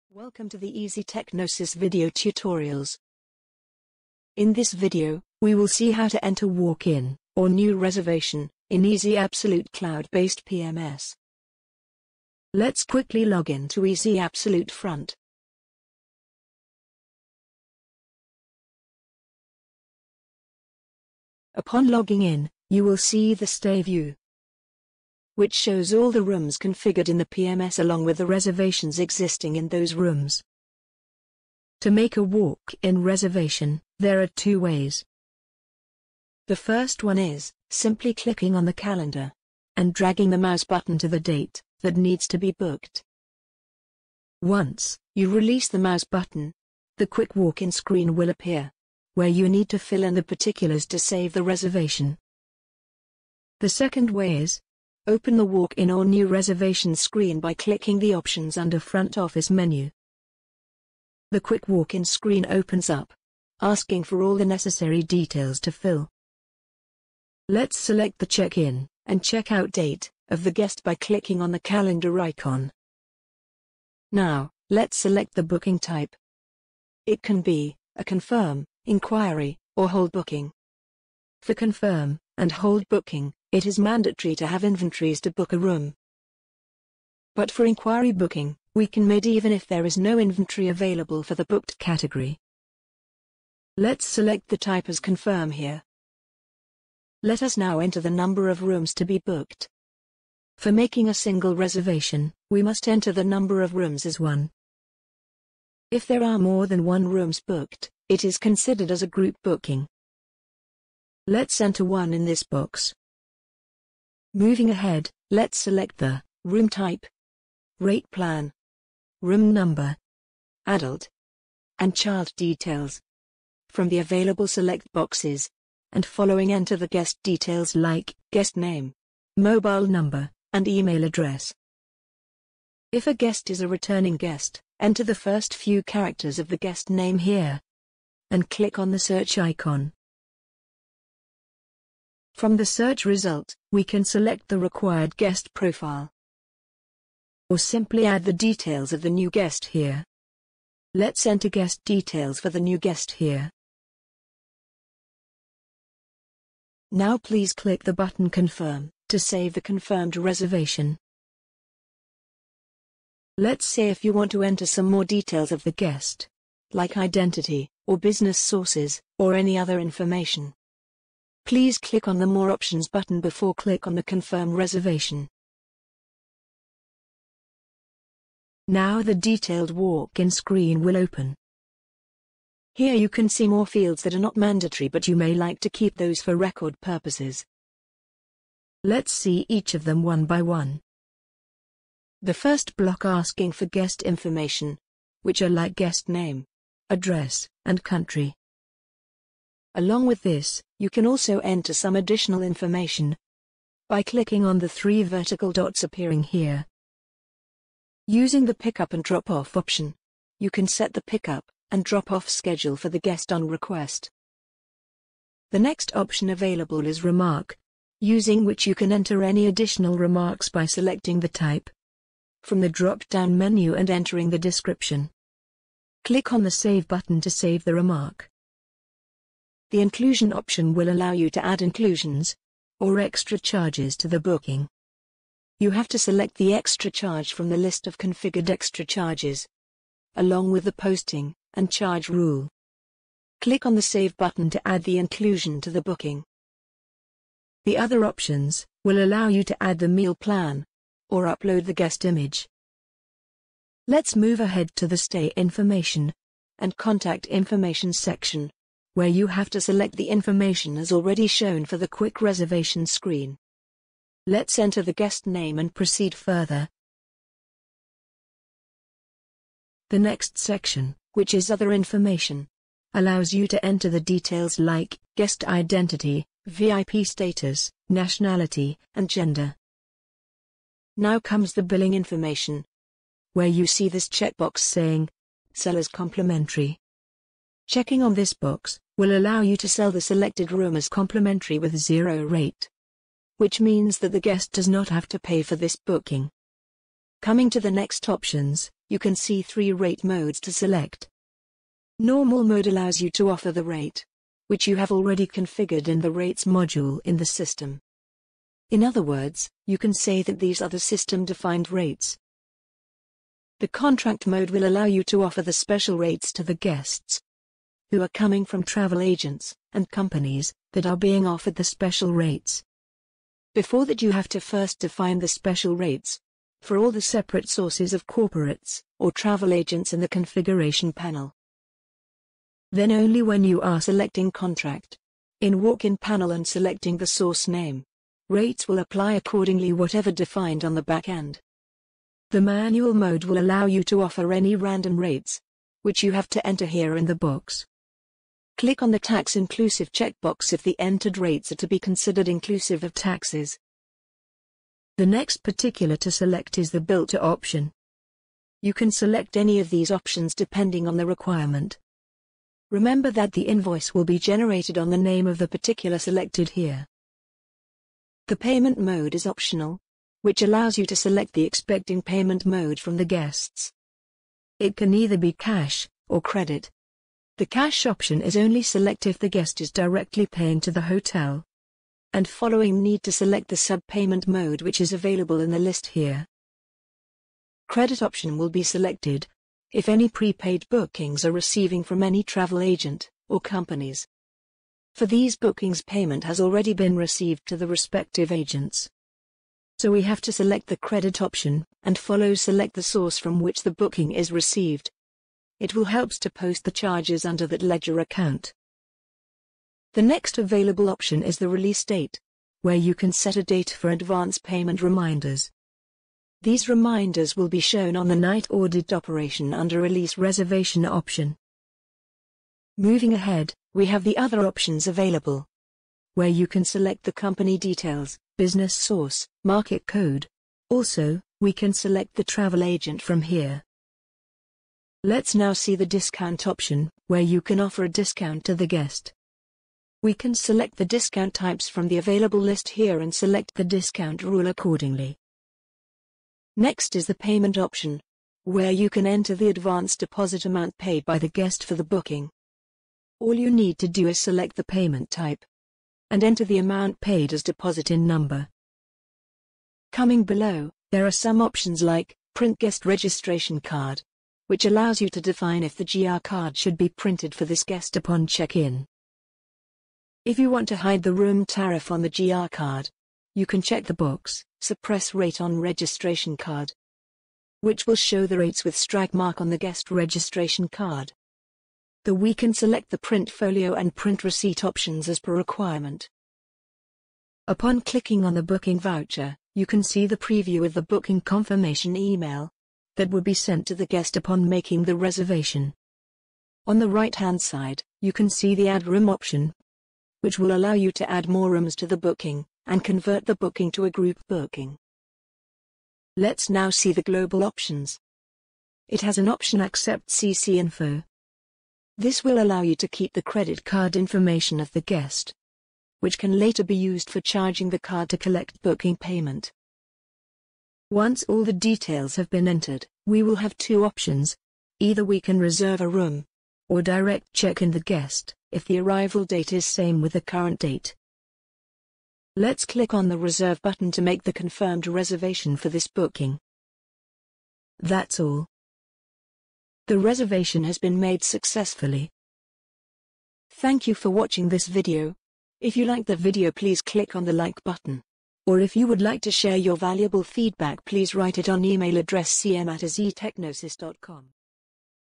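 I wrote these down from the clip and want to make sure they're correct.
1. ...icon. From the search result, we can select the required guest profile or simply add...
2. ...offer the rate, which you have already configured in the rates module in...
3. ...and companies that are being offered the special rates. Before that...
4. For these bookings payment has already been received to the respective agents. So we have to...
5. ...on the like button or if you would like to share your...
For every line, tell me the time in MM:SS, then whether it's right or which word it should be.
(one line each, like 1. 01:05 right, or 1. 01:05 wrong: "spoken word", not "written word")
1. 02:19 right
2. 05:03 right
3. 05:19 right
4. 06:34 right
5. 09:07 right.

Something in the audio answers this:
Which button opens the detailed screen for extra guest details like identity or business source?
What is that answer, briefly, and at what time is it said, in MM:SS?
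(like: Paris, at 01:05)
More Options, at 02:52.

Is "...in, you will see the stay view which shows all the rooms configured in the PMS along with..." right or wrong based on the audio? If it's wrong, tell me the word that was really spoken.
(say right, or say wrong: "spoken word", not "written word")
right.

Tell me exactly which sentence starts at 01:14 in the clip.
Now, let's select the booking type.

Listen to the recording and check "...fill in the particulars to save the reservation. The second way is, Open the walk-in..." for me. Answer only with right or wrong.
right.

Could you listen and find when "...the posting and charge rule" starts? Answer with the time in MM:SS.
04:00.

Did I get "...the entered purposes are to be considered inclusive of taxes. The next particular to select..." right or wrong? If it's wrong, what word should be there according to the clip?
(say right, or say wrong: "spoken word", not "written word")
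wrong: "rates", not "purposes".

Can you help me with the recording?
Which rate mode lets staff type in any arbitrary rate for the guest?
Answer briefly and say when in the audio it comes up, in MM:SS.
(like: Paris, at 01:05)
manual mode, at 05:42.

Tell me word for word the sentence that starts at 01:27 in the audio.
But for inquiry booking, we can mid even if there is no inventory available for the booked category.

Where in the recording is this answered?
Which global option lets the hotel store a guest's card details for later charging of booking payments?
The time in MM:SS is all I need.
08:29.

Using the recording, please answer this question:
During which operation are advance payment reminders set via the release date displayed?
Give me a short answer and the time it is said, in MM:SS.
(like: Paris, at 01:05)
night audit, at 06:58.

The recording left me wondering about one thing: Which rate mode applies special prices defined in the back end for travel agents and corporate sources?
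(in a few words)
contract mode.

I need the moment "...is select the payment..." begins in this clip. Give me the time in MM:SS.
07:34.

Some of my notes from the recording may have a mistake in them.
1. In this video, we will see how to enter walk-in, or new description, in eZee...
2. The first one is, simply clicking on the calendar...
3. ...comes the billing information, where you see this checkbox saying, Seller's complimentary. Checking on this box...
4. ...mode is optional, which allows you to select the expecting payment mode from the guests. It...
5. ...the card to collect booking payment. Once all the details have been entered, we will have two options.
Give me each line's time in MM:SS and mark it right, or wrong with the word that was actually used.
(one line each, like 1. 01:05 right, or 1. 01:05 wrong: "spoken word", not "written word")
1. 00:04 wrong: "reservation", not "description"
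2. 00:36 right
3. 04:41 right
4. 06:08 right
5. 08:37 right.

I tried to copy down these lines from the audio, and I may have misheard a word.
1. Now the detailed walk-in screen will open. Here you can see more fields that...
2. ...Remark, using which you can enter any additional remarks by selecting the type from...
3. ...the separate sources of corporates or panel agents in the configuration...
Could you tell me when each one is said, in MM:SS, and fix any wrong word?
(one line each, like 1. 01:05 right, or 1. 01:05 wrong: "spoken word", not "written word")
1. 02:58 right
2. 03:37 right
3. 05:26 wrong: "travel", not "panel".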